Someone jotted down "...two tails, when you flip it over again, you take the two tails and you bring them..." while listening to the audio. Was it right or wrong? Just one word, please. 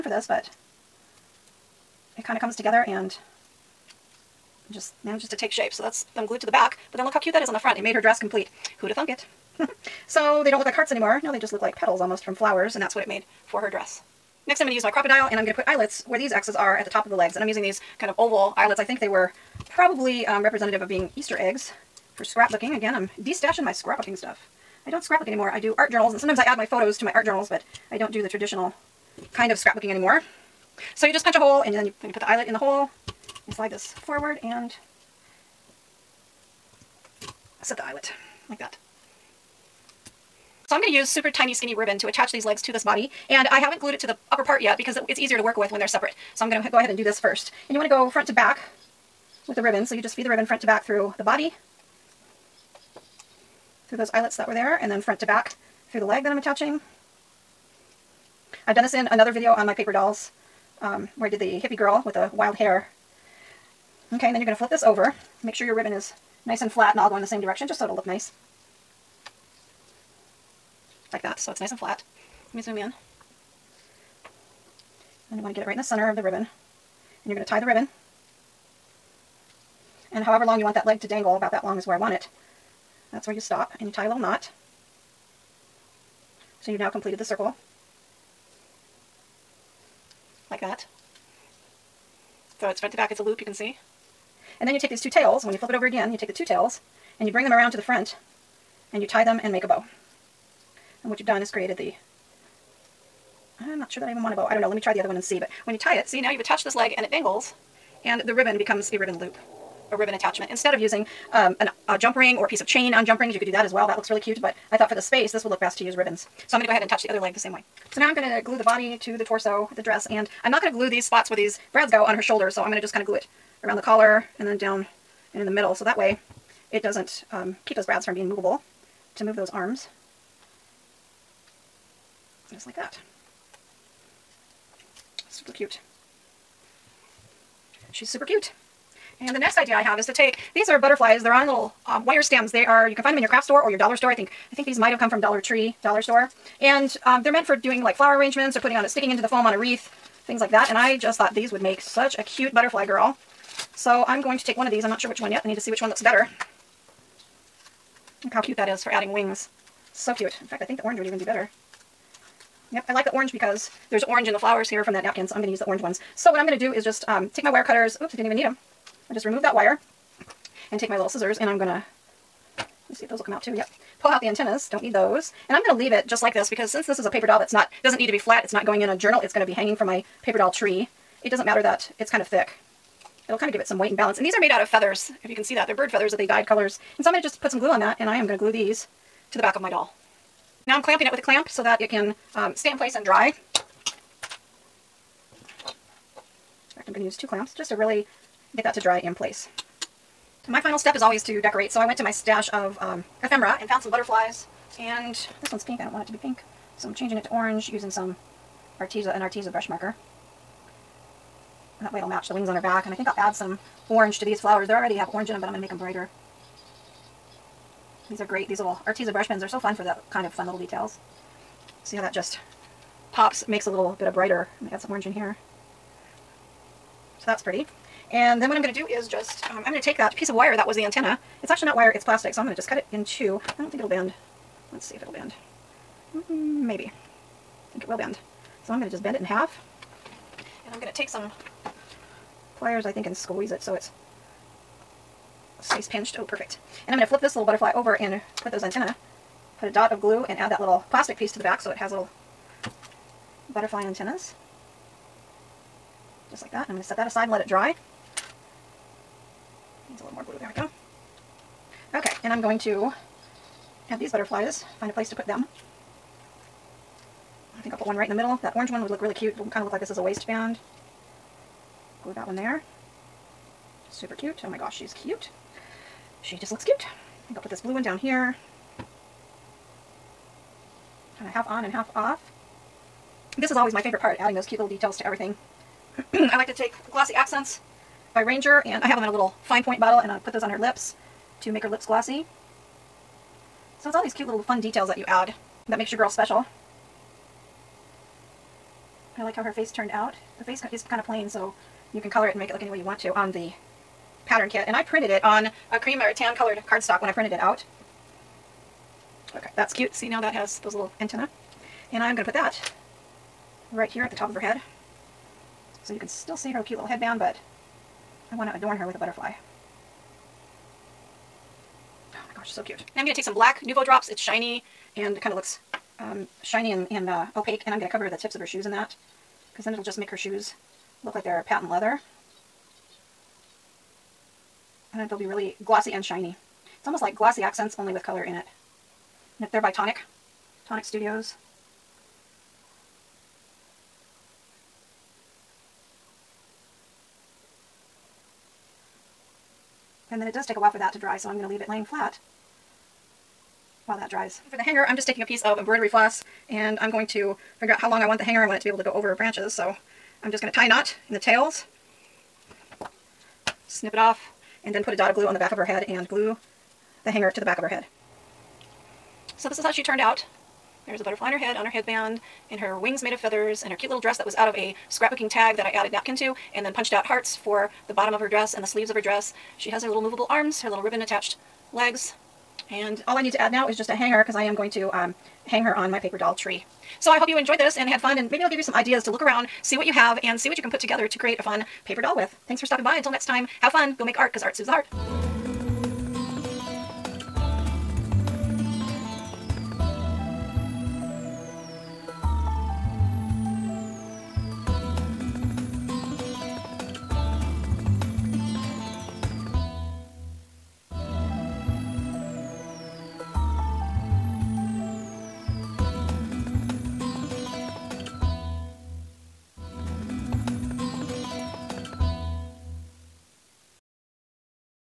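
right.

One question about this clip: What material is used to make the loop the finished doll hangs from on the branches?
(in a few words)
embroidery floss.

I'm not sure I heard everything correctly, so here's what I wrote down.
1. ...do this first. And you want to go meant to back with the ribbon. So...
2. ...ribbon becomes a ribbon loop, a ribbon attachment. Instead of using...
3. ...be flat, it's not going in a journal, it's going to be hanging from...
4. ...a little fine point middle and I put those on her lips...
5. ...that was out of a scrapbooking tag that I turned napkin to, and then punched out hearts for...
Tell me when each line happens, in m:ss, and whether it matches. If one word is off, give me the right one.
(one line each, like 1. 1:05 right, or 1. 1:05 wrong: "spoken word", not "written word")
1. 0:46 wrong: "front", not "meant"
2. 1:48 right
3. 2:58 right
4. 4:49 wrong: "bottle", not "middle"
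5. 6:14 wrong: "added", not "turned".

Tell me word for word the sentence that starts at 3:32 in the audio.
And I think I'll add some orange to these flowers.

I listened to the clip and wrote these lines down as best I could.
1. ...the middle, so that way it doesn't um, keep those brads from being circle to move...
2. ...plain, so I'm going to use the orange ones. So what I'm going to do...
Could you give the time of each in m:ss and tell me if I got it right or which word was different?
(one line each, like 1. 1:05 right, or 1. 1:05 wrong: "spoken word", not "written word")
1. 2:05 wrong: "movable", not "circle"
2. 2:45 wrong: "napkin", not "plain".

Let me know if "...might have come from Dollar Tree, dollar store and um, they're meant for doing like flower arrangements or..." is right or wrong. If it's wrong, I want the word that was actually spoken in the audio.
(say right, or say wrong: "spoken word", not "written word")
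right.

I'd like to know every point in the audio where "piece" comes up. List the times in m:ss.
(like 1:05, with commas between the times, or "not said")
1:52, 3:50, 4:11, 5:55.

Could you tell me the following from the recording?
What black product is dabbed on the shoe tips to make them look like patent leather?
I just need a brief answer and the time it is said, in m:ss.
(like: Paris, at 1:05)
Nuvo drops, at 5:23.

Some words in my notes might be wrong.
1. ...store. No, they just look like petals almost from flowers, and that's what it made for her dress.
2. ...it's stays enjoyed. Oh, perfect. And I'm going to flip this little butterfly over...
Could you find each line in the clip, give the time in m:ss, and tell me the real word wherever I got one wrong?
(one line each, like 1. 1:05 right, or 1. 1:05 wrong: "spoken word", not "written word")
1. 0:10 wrong: "anymore", not "store"
2. 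4:03 wrong: "pinched", not "enjoyed".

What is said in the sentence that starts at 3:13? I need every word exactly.
In fact, I'm going to use two clamps just to really get that to dry in place.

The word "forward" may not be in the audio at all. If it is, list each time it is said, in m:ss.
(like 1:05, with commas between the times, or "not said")
0:33.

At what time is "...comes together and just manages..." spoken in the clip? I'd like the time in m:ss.
0:02.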